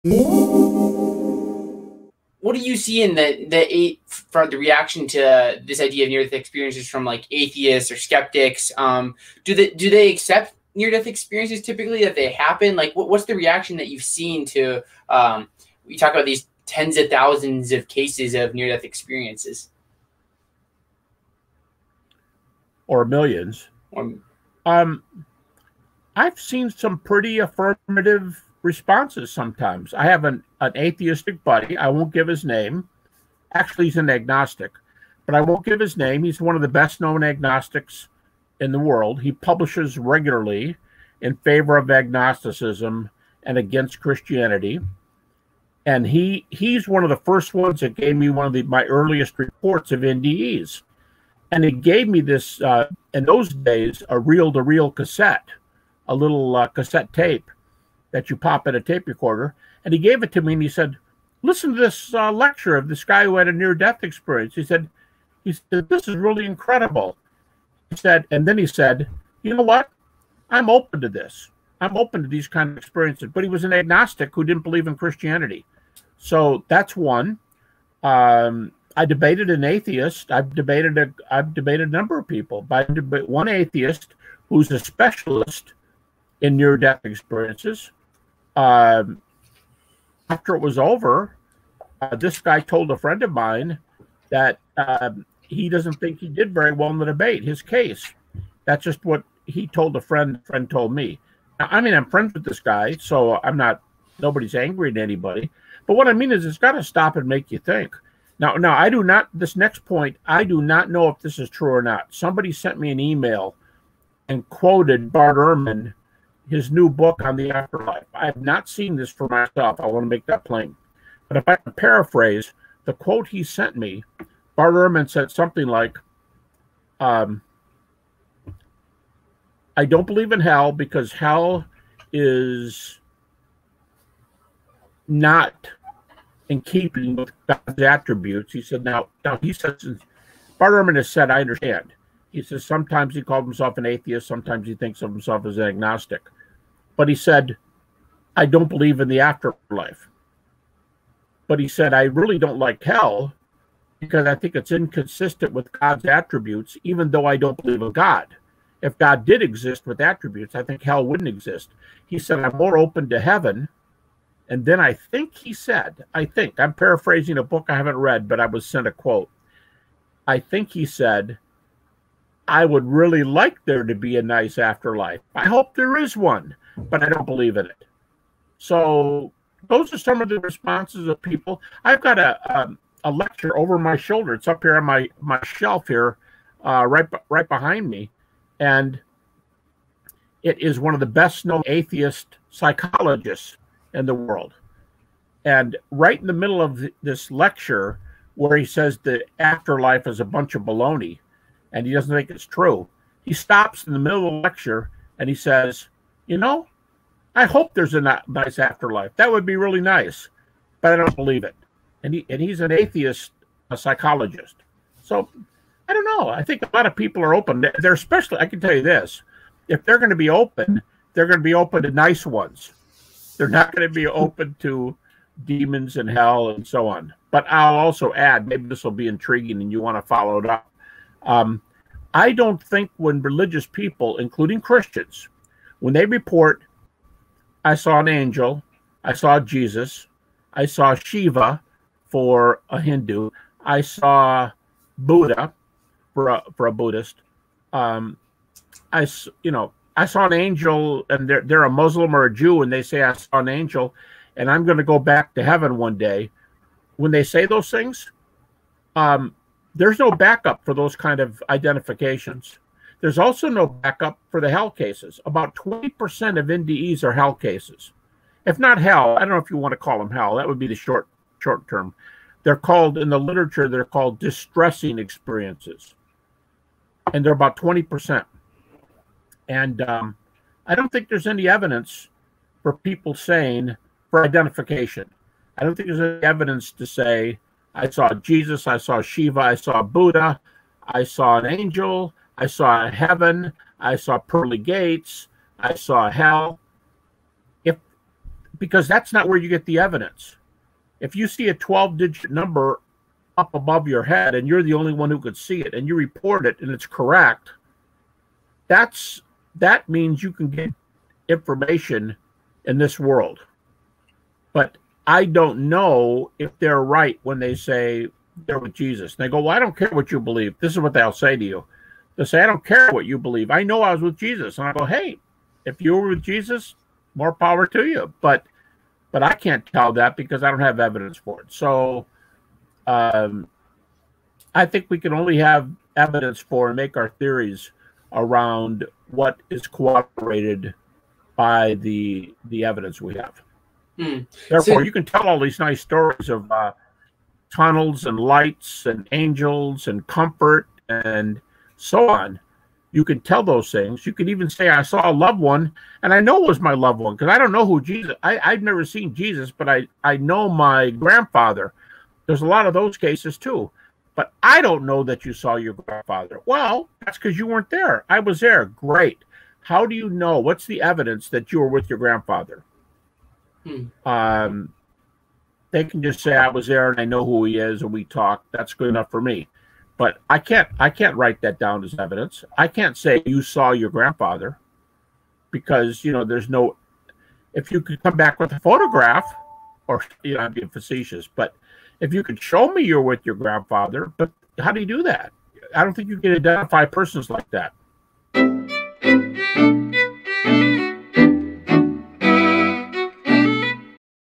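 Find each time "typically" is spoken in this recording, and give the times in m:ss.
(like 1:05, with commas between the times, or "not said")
0:11.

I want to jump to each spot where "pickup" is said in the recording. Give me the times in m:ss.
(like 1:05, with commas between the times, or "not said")
not said.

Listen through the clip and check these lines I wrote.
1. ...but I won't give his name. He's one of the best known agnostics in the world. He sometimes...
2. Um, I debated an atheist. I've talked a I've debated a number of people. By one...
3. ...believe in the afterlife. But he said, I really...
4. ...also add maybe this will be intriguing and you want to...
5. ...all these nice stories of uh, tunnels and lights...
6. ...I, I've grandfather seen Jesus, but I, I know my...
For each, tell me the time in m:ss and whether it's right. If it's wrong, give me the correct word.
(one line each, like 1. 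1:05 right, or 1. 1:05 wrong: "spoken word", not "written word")
1. 0:35 wrong: "publishes", not "sometimes"
2. 1:18 wrong: "debated", not "talked"
3. 2:28 right
4. 3:47 right
5. 5:45 right
6. 5:58 wrong: "never", not "grandfather".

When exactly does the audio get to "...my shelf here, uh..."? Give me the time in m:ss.
3:05.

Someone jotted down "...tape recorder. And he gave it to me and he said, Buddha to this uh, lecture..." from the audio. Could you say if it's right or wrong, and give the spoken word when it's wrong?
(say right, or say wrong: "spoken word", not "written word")
wrong: "Listen", not "Buddha".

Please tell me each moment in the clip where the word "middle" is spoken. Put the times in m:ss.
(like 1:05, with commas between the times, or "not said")
3:16, 3:23.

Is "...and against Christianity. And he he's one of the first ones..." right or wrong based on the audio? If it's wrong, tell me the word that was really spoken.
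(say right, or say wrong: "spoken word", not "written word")
right.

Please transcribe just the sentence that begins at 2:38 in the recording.
If God did exist with attributes, I think hell wouldn't exist.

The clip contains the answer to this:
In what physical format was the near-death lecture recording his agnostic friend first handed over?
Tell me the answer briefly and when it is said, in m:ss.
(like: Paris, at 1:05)
reel to reel cassette, at 0:54.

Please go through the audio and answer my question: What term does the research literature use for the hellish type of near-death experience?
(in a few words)
distressing experiences.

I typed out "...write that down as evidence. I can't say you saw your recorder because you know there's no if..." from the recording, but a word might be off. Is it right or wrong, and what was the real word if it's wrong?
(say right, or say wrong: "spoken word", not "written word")
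wrong: "grandfather", not "recorder".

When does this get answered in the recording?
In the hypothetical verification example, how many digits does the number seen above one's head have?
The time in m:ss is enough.
5:01.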